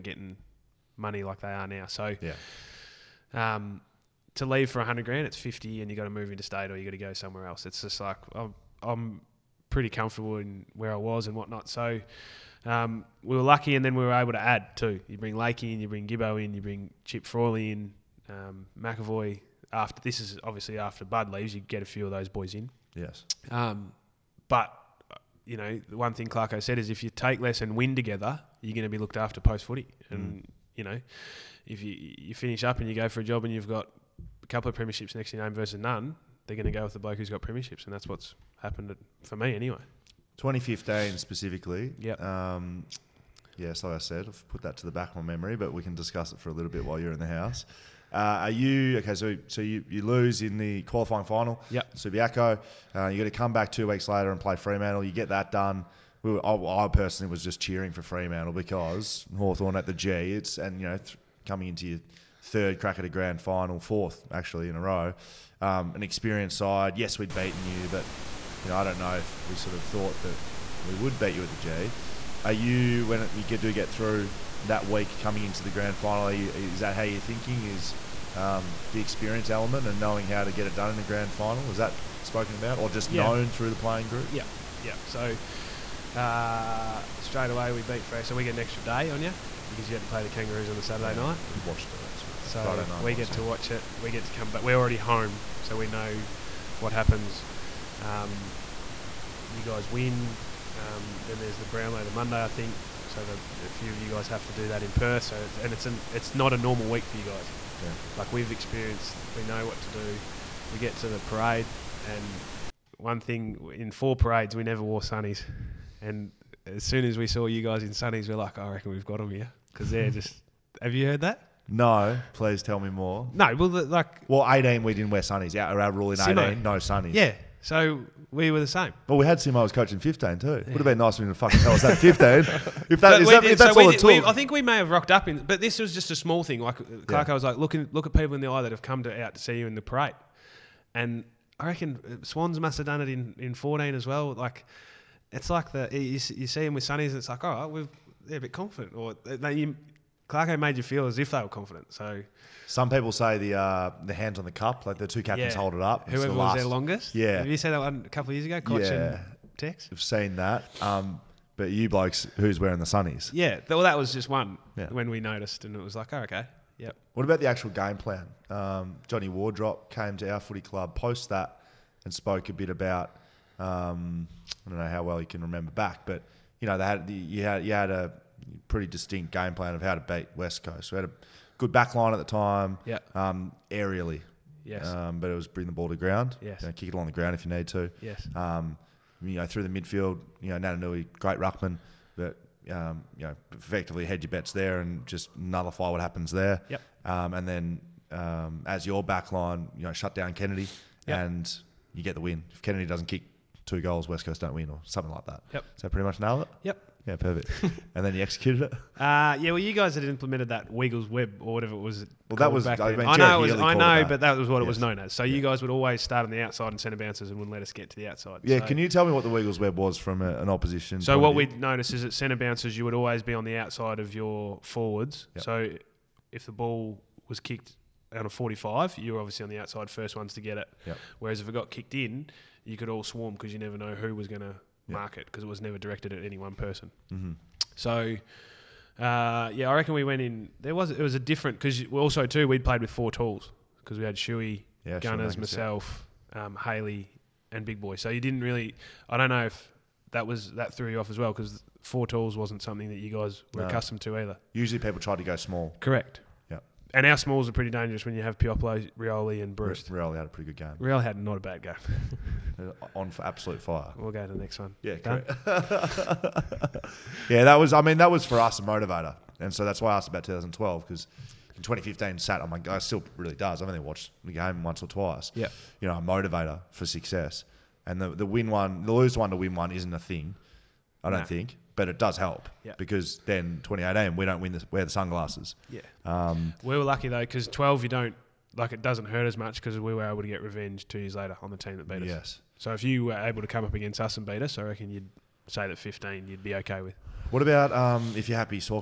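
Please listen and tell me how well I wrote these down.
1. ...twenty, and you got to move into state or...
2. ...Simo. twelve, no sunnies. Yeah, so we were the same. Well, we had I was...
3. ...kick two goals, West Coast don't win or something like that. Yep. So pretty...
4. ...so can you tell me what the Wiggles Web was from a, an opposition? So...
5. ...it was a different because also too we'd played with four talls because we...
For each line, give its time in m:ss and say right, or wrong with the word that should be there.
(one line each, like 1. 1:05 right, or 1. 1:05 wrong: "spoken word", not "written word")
1. 0:05 wrong: "fifty", not "twenty"
2. 2:06 wrong: "eighteen", not "twelve"
3. 3:23 right
4. 3:38 right
5. 4:00 right.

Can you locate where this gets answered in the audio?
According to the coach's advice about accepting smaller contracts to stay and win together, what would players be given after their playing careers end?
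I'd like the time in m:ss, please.
0:28.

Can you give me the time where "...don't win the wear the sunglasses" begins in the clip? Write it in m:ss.
4:44.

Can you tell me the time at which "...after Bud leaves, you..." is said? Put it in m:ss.
0:20.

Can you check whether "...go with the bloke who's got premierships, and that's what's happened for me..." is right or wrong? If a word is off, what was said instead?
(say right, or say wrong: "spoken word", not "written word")
right.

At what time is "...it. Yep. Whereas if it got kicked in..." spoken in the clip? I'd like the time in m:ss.
3:50.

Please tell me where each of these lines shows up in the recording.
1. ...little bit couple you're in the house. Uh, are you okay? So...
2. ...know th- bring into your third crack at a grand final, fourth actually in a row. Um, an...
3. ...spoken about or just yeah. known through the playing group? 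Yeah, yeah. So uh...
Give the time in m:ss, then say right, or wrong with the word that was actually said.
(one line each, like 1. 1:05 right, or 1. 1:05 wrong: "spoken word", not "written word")
1. 0:46 wrong: "while", not "couple"
2. 1:00 wrong: "coming", not "bring"
3. 1:22 right.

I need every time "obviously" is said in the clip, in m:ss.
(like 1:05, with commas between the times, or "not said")
0:20, 3:49.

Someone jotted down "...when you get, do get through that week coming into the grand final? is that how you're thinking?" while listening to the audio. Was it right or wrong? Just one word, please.
right.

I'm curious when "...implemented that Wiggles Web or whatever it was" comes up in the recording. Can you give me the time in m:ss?
3:30.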